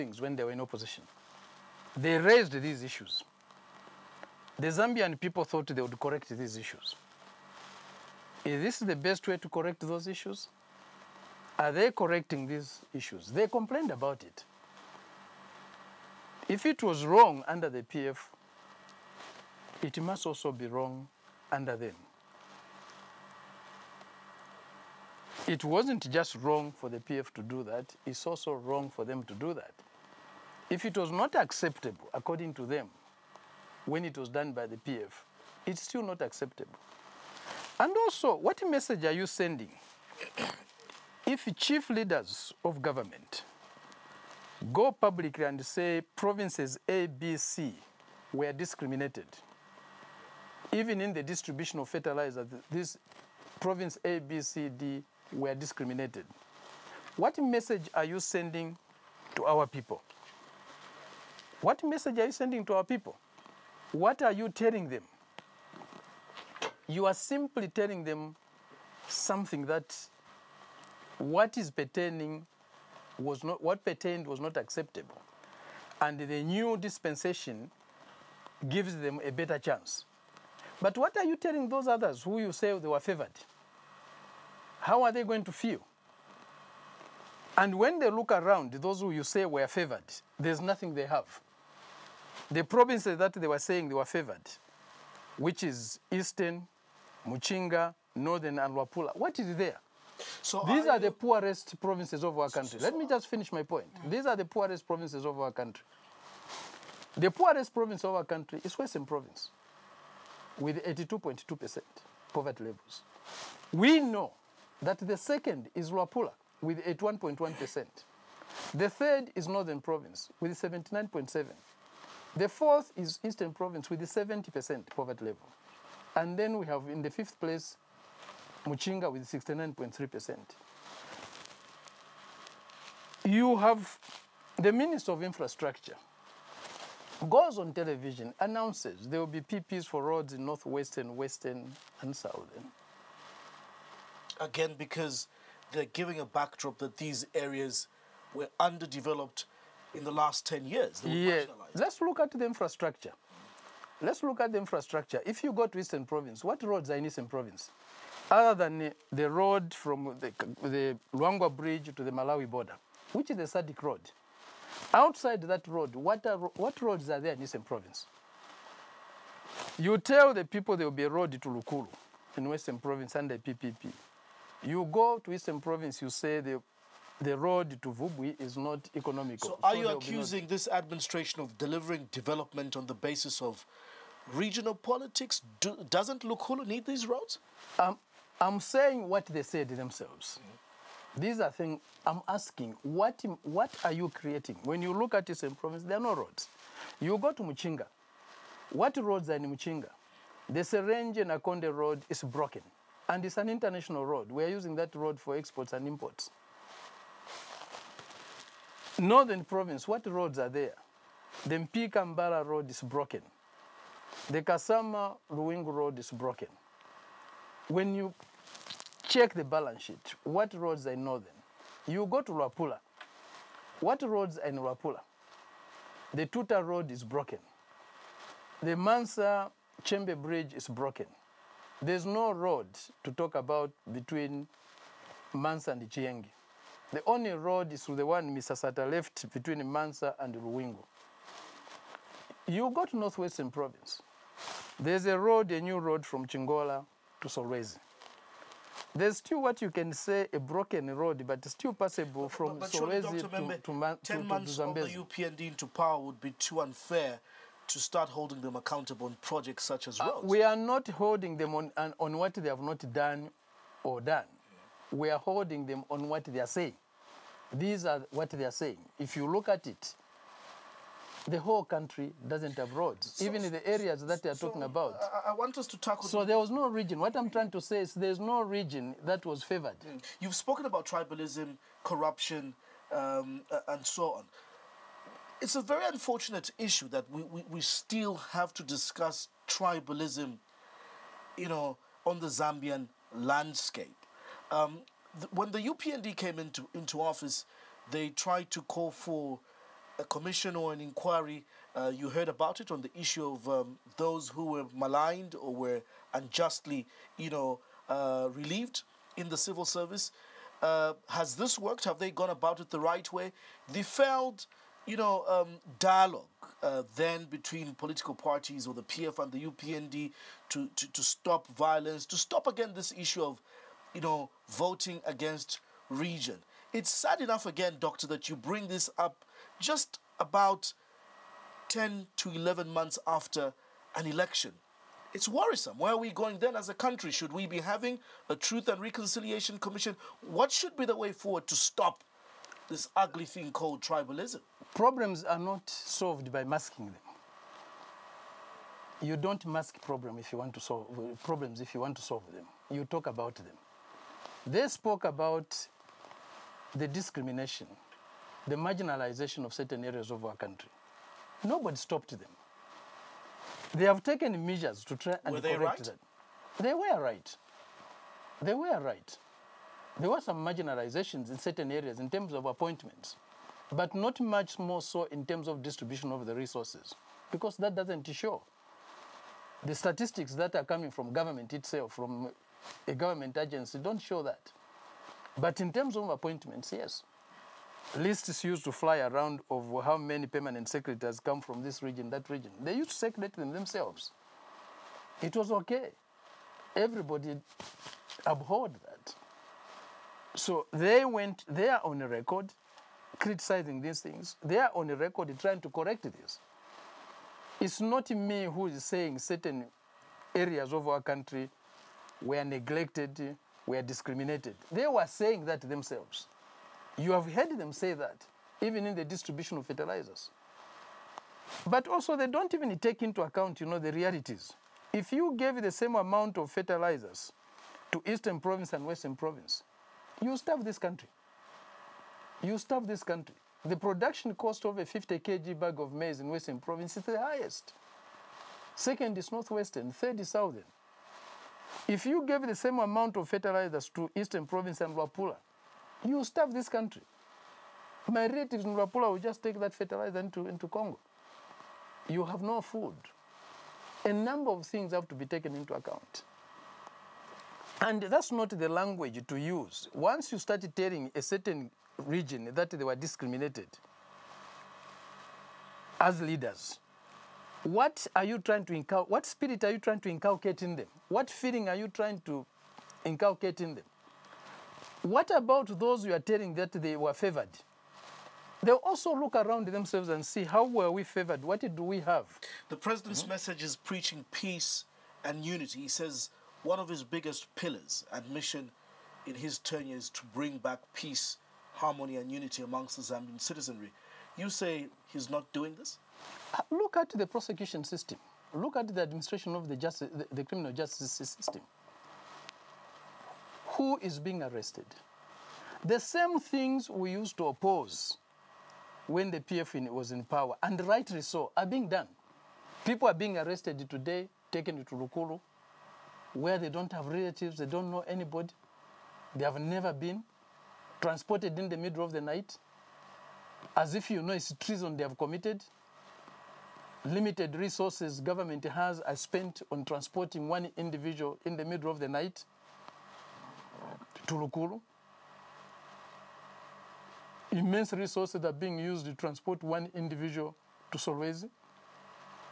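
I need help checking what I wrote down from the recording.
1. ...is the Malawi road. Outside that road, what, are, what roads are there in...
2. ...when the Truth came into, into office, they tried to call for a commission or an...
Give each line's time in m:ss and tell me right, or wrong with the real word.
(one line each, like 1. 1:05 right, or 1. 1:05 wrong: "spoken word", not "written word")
1. 2:43 wrong: "SADC", not "Malawi"
2. 4:55 wrong: "UPND", not "Truth".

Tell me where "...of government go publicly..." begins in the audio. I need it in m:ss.
0:42.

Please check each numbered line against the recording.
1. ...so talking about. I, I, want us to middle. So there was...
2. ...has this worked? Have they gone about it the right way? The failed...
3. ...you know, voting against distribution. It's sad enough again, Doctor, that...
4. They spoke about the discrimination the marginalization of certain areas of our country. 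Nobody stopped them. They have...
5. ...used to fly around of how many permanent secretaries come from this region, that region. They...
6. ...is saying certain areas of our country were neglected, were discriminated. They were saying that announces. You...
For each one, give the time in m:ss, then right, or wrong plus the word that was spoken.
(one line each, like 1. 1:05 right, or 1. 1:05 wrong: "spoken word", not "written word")
1. 4:34 wrong: "tackle", not "middle"
2. 5:11 right
3. 5:23 wrong: "region", not "distribution"
4. 5:54 right
5. 6:28 right
6. 6:48 wrong: "themselves", not "announces".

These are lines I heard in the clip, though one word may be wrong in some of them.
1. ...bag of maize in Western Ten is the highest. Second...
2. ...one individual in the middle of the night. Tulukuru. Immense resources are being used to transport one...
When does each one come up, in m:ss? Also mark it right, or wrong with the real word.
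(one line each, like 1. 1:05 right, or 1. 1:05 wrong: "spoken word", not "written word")
1. 7:15 wrong: "Province", not "Ten"
2. 8:50 right.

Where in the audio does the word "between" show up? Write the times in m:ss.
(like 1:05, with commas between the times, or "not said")
3:53, 3:59, 5:17.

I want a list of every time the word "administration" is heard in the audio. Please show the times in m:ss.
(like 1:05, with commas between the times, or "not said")
3:00, 8:19.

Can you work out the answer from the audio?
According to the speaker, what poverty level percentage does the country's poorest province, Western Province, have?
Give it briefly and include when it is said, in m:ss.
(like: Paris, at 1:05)
82.2%, at 1:50.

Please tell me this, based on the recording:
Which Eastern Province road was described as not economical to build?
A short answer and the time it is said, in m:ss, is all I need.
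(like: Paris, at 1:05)
Vubwi, at 2:57.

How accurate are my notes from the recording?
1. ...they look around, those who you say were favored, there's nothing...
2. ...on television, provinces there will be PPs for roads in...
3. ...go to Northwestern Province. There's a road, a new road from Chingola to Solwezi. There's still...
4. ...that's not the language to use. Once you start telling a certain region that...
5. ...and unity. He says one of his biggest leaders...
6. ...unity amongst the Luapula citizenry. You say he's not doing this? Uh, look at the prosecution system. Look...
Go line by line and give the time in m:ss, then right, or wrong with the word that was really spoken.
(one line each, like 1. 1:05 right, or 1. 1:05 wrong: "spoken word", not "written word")
1. 1:27 right
2. 2:17 wrong: "announces", not "provinces"
3. 4:02 right
4. 7:38 right
5. 8:05 wrong: "pillars", not "leaders"
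6. 8:12 wrong: "Zambian", not "Luapula".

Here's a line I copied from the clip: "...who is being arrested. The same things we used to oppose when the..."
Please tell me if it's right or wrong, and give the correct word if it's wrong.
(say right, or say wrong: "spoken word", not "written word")
right.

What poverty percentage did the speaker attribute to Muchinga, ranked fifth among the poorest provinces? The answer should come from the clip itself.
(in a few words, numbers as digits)
69.3%.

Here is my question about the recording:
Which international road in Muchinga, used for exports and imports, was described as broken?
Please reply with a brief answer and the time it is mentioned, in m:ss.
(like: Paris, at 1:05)
Serenje Nakonde Road, at 3:20.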